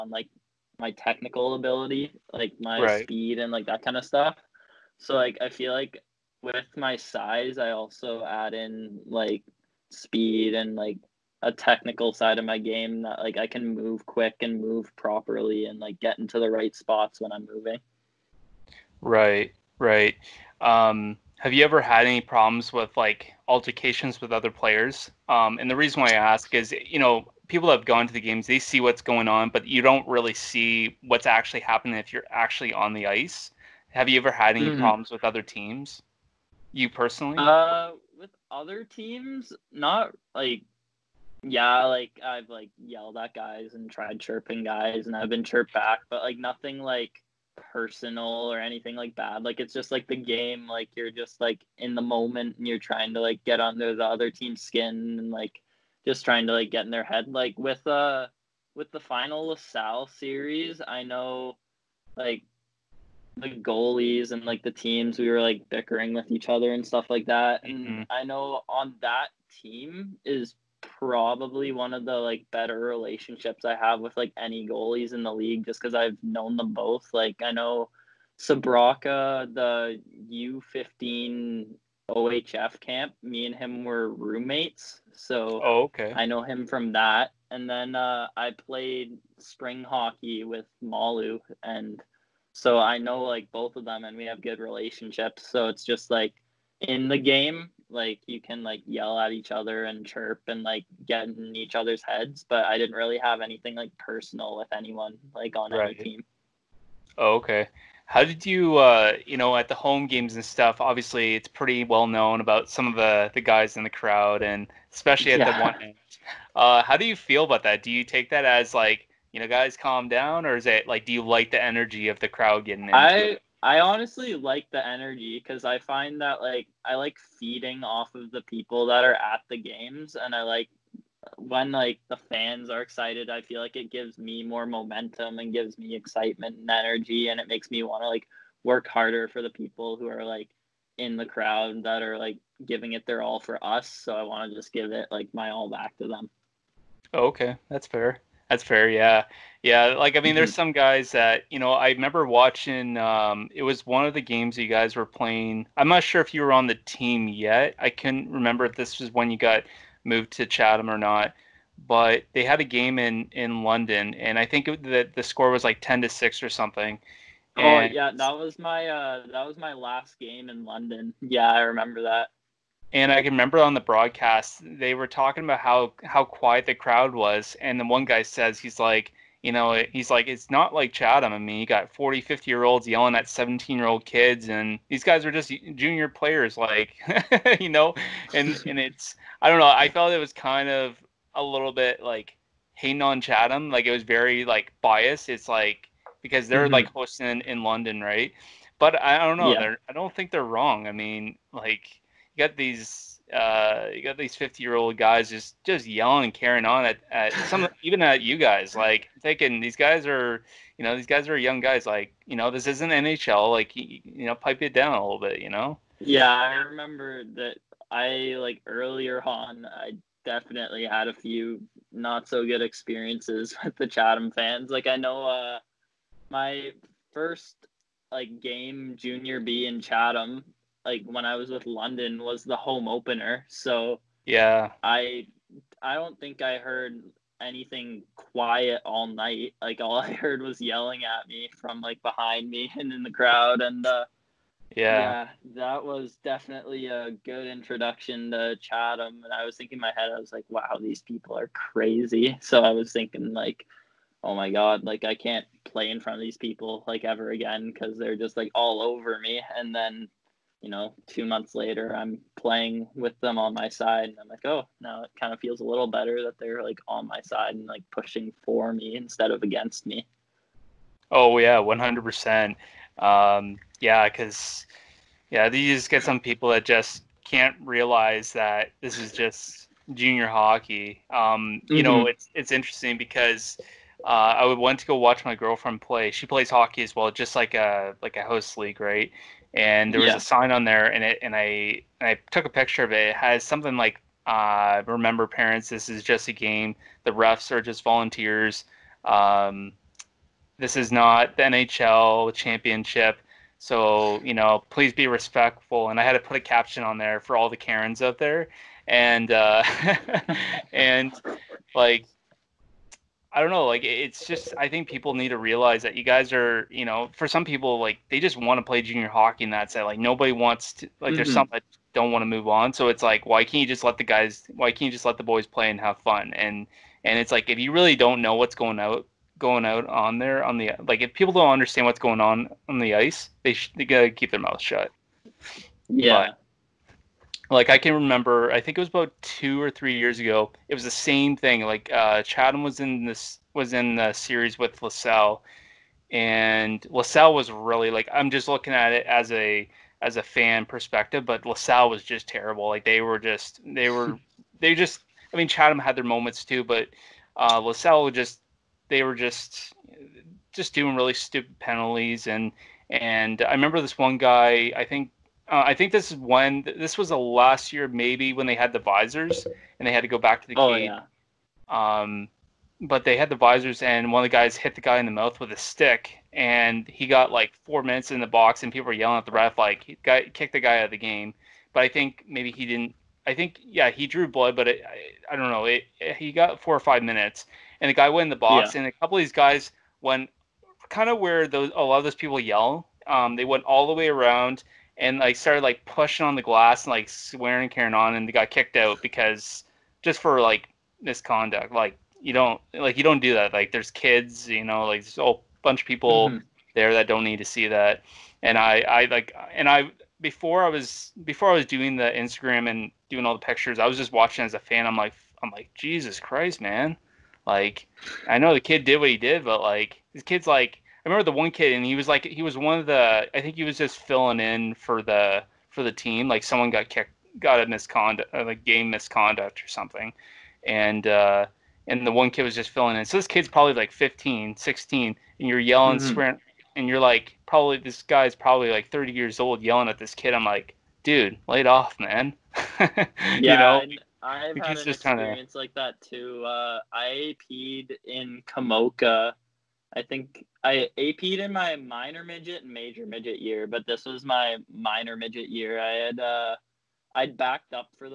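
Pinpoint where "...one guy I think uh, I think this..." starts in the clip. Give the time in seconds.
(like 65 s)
363 s.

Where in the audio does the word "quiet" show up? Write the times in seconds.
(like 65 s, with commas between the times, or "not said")
176 s, 238 s.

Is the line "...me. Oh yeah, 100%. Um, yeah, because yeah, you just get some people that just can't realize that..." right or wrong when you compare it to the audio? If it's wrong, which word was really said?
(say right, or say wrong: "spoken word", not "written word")
right.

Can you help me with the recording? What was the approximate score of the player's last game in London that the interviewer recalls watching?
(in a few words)
10 to 6.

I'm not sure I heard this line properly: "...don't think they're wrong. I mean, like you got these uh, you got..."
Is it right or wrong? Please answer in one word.
right.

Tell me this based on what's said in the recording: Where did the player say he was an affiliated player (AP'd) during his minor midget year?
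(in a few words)
Komoka.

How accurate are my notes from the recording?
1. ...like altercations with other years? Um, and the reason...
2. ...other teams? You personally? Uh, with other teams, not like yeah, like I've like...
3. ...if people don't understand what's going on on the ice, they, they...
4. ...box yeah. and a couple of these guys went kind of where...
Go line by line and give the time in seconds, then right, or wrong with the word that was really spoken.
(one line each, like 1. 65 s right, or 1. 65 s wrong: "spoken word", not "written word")
1. 22 s wrong: "players", not "years"
2. 35 s right
3. 331 s right
4. 388 s right.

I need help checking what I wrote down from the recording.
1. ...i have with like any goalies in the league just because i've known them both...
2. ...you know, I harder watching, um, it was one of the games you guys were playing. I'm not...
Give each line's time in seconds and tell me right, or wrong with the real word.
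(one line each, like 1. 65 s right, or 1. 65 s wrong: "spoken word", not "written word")
1. 73 s right
2. 151 s wrong: "remember", not "harder".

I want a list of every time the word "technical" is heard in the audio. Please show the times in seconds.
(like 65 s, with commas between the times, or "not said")
0 s, 11 s.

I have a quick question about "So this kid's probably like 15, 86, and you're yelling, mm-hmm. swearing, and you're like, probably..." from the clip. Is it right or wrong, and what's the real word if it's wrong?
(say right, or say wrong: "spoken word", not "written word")
wrong: "16", not "86".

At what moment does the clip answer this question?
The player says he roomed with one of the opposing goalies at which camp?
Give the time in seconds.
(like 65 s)
80 s.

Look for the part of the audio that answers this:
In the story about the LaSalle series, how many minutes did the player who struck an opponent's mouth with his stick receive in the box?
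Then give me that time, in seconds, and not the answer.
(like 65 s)
377 s.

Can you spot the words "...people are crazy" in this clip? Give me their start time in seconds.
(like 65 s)
251 s.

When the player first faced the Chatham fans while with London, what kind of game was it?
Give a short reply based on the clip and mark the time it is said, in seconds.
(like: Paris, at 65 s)
Home opener, at 232 s.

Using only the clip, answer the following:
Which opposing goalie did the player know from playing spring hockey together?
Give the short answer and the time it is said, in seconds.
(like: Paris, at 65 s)
Malu, at 90 s.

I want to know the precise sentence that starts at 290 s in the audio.
a sign on there and it and I and I took a picture of it.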